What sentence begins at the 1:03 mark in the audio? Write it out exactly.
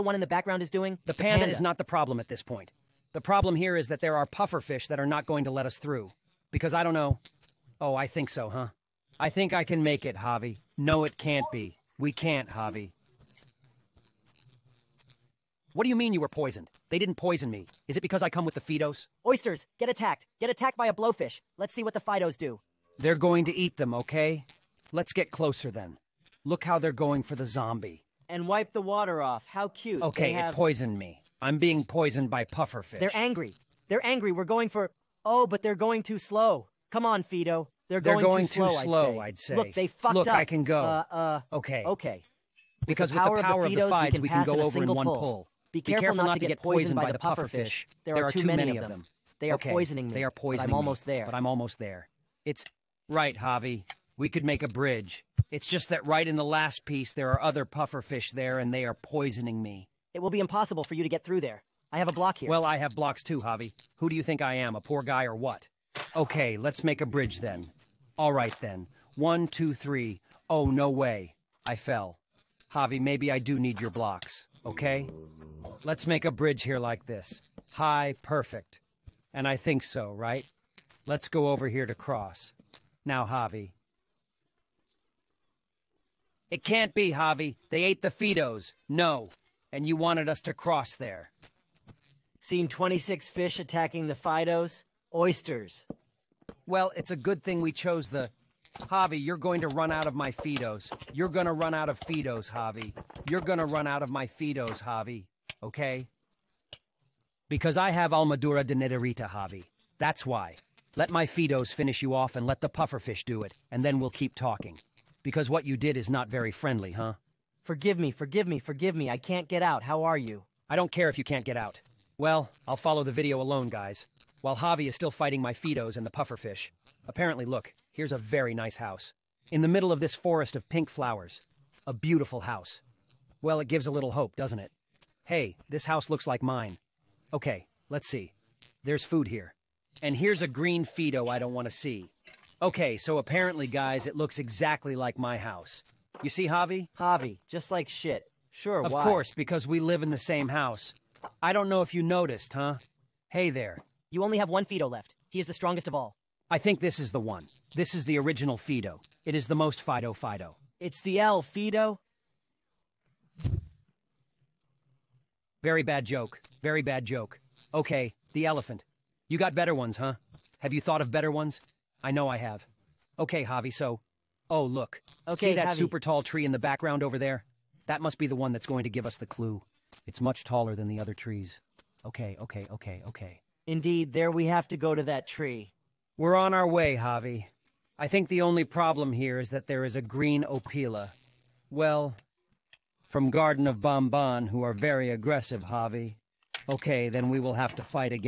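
Who do you think I am, a poor guy or what?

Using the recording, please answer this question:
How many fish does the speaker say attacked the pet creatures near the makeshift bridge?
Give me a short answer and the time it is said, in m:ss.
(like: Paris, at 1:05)
26, at 1:32.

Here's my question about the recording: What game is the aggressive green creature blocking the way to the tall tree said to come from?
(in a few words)
Garten of Banban.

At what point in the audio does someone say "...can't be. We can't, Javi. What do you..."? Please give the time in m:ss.
0:11.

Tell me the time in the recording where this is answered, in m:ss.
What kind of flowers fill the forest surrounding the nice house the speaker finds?
2:10.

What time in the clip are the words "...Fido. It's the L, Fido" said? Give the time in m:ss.
2:40.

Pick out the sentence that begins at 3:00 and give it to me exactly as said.
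It's much taller than the other trees.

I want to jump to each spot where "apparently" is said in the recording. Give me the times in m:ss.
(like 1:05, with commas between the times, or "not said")
2:07, 2:23.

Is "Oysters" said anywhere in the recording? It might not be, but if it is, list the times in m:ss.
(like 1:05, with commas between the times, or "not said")
0:19, 1:35.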